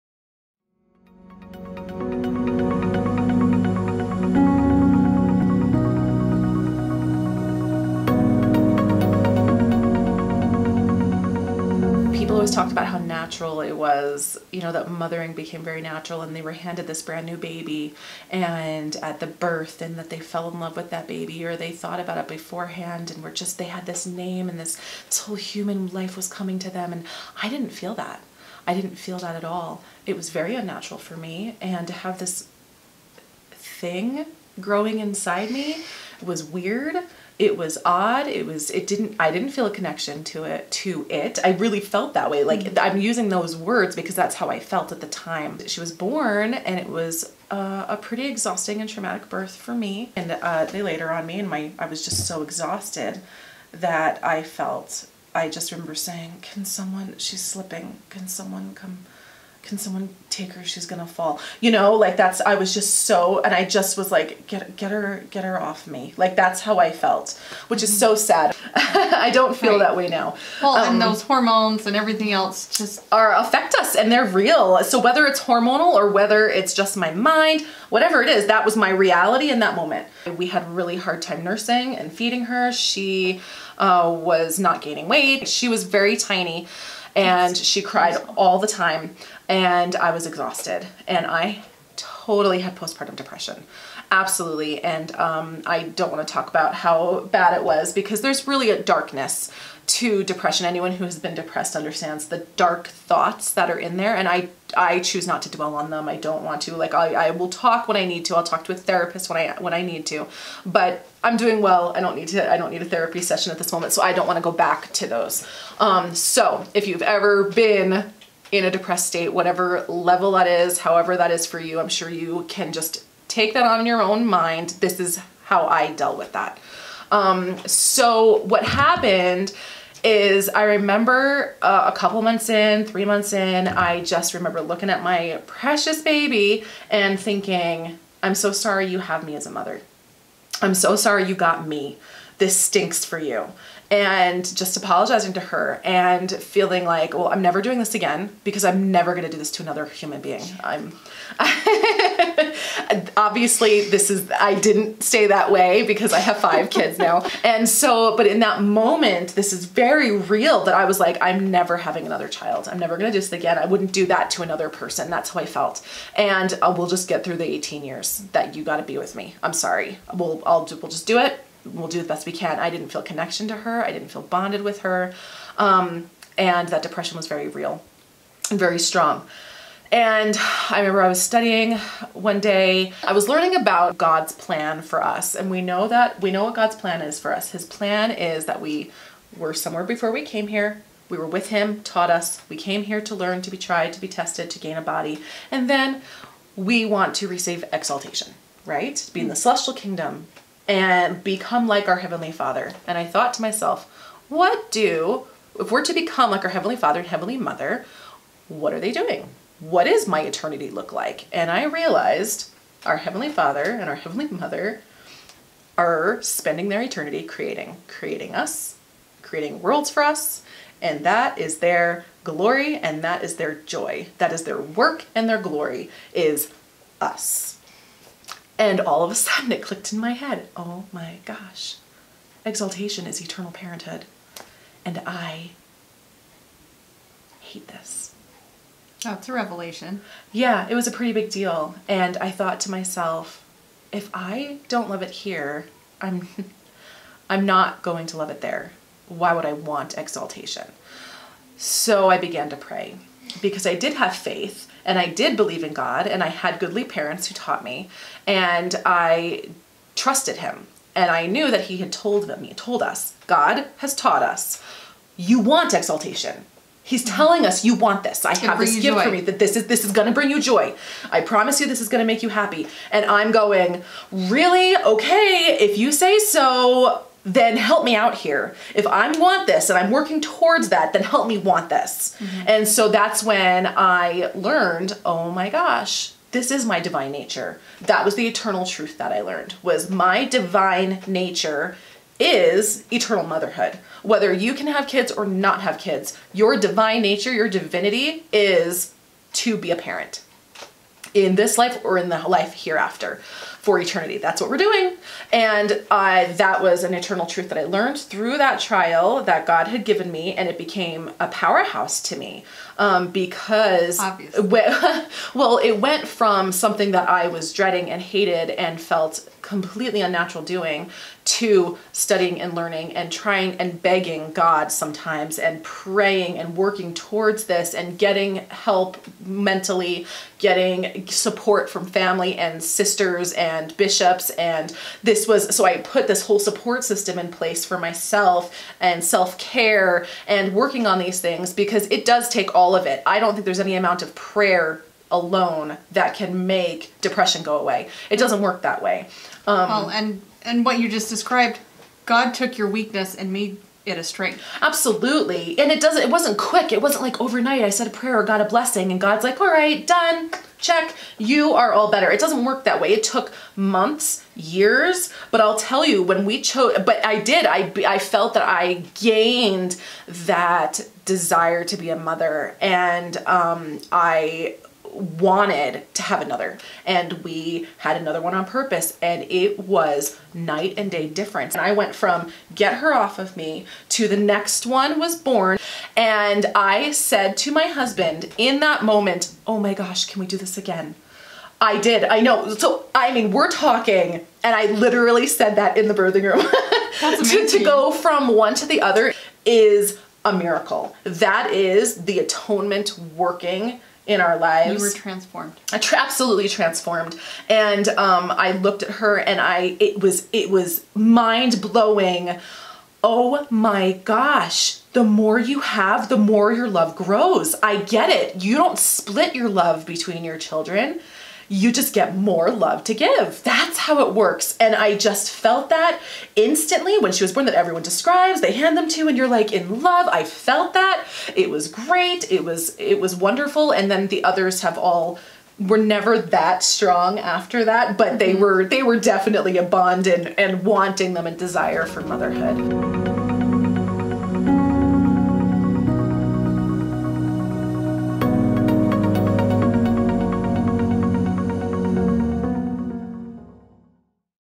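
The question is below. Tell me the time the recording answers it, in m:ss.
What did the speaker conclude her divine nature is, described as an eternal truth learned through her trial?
4:52.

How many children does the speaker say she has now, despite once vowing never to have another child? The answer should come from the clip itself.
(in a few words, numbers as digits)
5.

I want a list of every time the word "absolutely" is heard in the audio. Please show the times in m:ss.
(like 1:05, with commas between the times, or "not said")
1:34, 5:54, 6:45.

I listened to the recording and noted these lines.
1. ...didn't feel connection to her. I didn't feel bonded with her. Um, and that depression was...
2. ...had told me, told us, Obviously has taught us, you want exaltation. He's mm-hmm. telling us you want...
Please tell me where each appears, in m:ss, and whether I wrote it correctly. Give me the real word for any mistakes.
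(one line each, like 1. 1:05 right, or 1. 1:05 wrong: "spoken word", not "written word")
1. 2:52 right
2. 4:21 wrong: "God", not "Obviously".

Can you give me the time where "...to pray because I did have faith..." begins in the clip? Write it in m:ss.
4:12.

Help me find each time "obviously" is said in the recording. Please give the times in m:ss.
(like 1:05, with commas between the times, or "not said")
2:33, 5:13.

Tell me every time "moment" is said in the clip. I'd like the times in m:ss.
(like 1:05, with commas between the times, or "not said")
1:19, 1:53, 2:38, 6:28.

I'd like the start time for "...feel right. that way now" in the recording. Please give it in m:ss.
1:09.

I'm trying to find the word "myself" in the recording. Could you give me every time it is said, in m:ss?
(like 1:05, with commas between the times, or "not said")
3:23, 4:02, 5:37.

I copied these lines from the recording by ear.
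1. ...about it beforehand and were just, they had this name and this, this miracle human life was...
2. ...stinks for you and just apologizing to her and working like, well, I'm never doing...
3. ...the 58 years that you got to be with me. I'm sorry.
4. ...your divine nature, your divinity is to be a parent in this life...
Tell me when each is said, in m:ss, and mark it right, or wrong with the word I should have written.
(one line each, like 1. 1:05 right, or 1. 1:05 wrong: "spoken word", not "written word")
1. 0:22 wrong: "whole", not "miracle"
2. 2:22 wrong: "feeling", not "working"
3. 2:47 wrong: "18", not "58"
4. 4:56 right.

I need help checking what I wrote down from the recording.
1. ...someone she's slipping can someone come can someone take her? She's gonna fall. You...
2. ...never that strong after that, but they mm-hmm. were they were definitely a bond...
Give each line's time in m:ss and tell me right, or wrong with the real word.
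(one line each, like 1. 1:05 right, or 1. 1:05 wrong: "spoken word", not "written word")
1. 0:56 right
2. 7:15 right.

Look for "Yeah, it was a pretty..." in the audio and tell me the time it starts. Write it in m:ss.
4:00.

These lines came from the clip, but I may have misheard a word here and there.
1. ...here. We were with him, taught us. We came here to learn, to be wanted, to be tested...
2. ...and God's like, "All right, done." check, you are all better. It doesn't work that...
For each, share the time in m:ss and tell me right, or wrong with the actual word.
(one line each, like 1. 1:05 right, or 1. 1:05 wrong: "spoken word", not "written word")
1. 3:10 wrong: "tried", not "wanted"
2. 5:58 right.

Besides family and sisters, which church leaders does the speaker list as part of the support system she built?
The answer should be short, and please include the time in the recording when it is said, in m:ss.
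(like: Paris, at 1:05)
bishops, at 5:33.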